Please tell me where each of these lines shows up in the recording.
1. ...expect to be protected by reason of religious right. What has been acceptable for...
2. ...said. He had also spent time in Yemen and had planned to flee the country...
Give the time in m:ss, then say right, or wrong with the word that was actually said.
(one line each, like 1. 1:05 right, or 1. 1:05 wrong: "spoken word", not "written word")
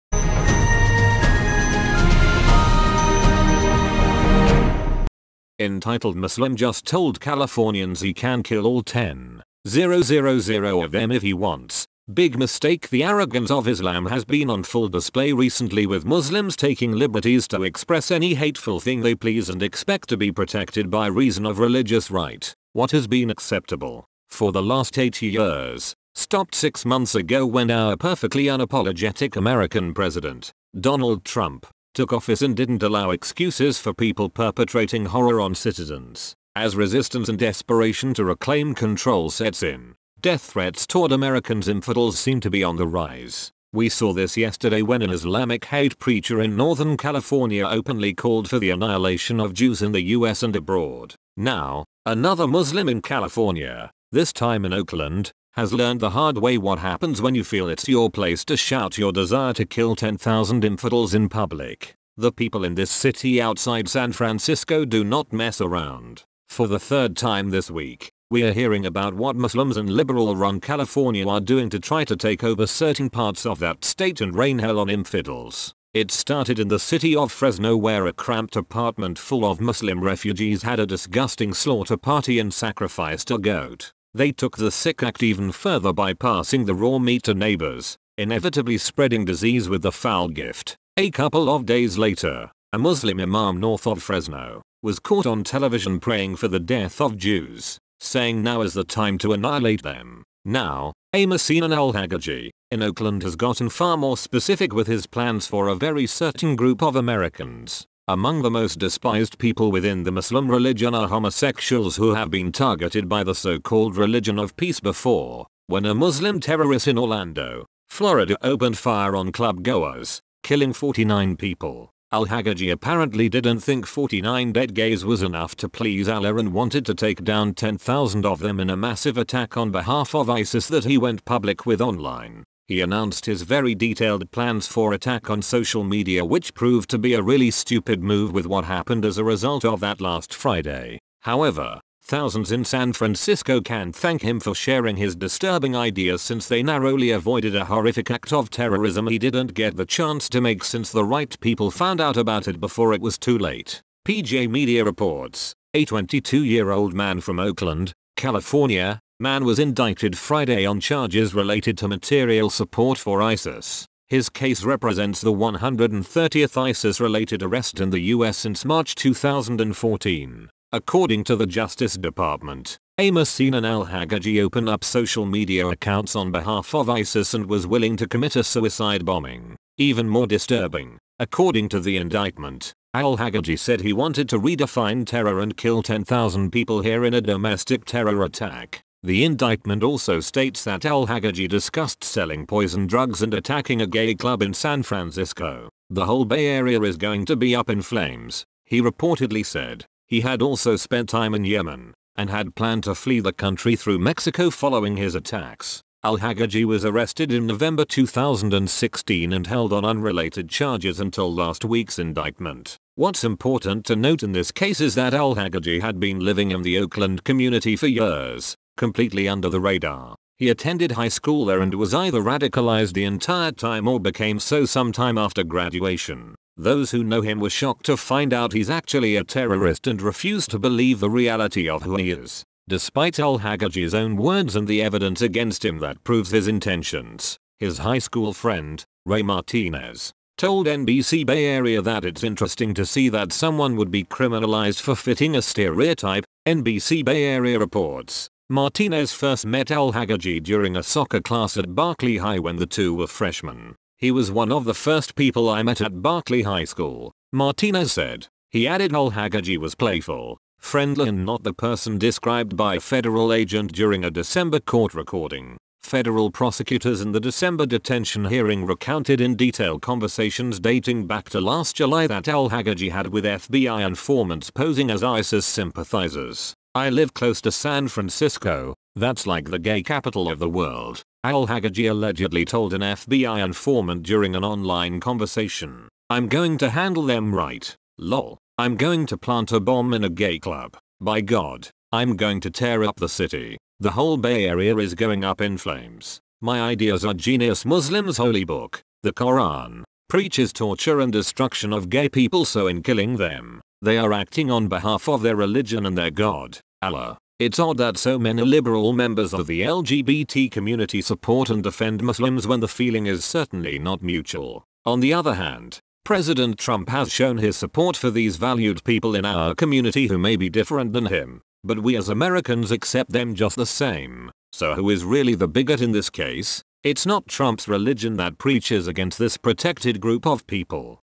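1. 0:19 right
2. 3:19 right.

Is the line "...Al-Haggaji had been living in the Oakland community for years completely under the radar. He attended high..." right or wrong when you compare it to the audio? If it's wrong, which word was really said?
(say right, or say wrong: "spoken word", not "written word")
right.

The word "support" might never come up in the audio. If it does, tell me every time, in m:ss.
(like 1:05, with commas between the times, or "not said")
2:42, 5:11, 5:17.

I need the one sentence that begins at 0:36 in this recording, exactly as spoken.
As resistance and desperation to reclaim control sets in, death threats toward Americans infidels seem to be on the rise.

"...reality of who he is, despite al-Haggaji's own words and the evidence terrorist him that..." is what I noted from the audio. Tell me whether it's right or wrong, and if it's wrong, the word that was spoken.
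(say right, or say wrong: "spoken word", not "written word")
wrong: "against", not "terrorist".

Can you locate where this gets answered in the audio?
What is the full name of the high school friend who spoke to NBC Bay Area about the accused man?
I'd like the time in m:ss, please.
3:59.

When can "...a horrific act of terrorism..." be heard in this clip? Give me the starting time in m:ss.
2:27.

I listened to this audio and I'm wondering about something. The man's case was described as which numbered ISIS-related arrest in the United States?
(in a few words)
130th.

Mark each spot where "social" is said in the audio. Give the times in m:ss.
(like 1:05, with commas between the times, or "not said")
2:15, 2:54.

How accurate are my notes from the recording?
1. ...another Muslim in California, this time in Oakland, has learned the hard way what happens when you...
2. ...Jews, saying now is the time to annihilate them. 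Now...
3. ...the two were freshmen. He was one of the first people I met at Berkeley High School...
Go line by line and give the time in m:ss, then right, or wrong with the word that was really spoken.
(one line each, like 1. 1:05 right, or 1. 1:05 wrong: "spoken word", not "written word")
1. 0:52 right
2. 1:37 right
3. 4:12 right.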